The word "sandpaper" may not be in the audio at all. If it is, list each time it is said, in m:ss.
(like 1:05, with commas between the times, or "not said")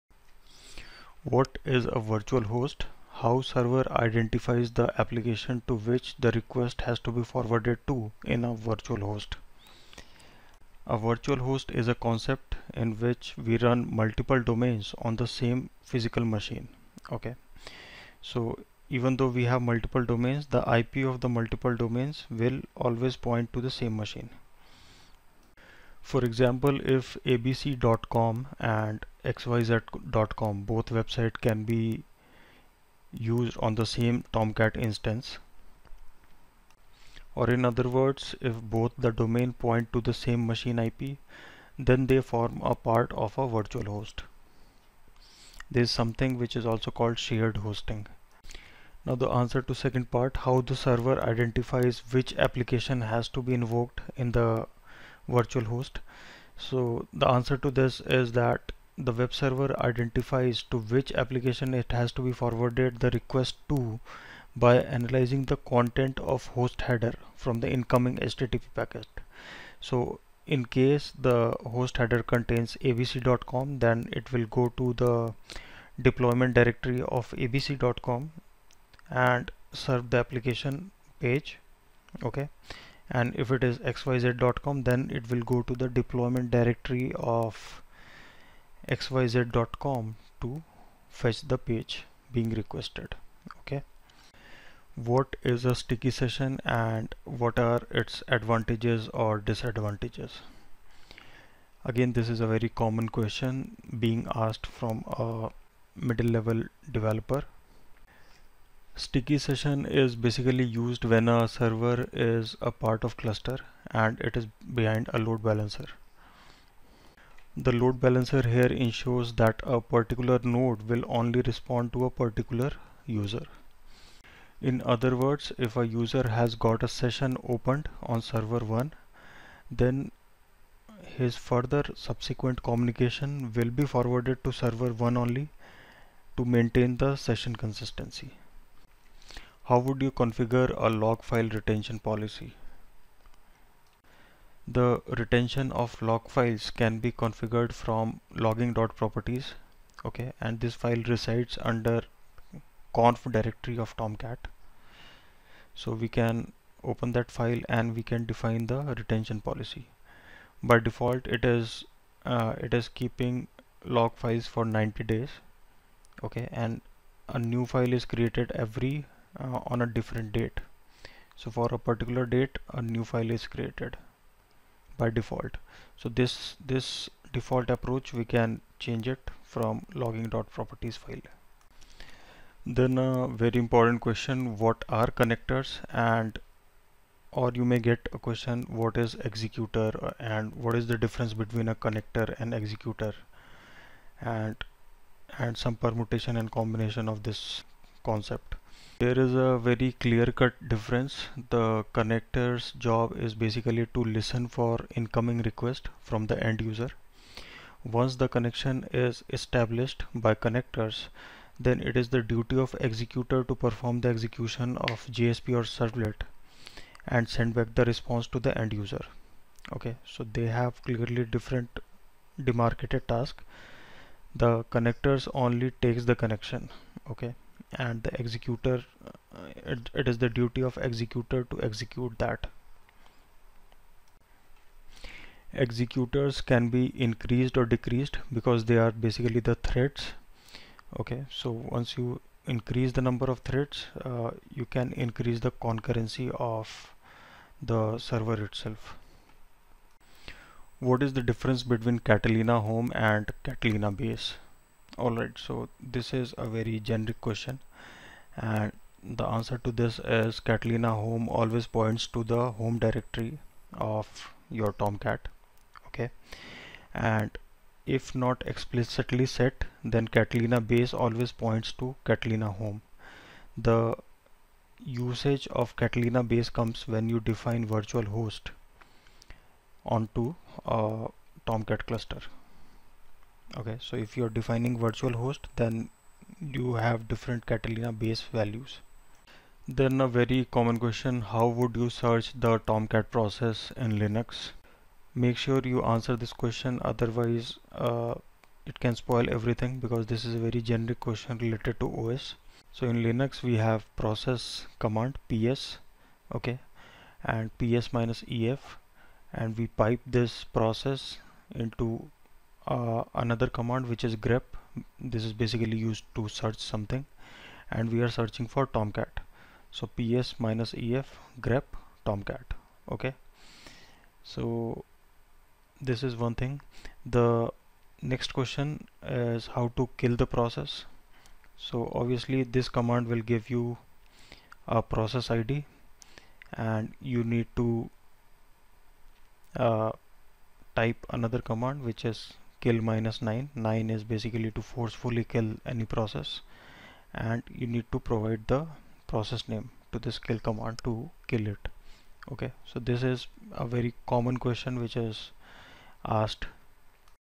not said.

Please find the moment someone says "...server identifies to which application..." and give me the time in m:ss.
0:59.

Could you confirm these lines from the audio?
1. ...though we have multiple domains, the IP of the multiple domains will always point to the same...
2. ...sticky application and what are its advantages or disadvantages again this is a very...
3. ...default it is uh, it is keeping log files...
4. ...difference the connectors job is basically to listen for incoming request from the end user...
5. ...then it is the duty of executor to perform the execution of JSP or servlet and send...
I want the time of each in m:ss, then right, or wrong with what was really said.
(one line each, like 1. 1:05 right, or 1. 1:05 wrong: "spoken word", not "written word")
1. 0:19 right
2. 1:35 wrong: "session", not "application"
3. 2:40 right
4. 3:20 right
5. 3:31 right.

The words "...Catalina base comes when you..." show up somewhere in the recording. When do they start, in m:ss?
4:35.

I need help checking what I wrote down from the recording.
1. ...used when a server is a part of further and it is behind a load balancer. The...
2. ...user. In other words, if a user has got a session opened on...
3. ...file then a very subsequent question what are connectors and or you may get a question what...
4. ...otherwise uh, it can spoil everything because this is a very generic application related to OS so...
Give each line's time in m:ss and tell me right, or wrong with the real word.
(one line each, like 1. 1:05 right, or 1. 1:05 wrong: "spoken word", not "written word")
1. 1:50 wrong: "cluster", not "further"
2. 2:03 right
3. 3:00 wrong: "important", not "subsequent"
4. 4:56 wrong: "question", not "application".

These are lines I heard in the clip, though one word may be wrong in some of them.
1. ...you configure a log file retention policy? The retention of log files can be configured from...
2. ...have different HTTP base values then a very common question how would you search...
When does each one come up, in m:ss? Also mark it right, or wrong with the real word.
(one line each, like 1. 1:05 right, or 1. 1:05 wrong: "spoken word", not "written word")
1. 2:20 right
2. 4:46 wrong: "Catalina", not "HTTP".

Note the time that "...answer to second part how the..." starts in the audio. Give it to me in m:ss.
0:49.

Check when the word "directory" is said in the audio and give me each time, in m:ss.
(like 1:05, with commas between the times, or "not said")
1:16, 1:26, 2:33, 4:22.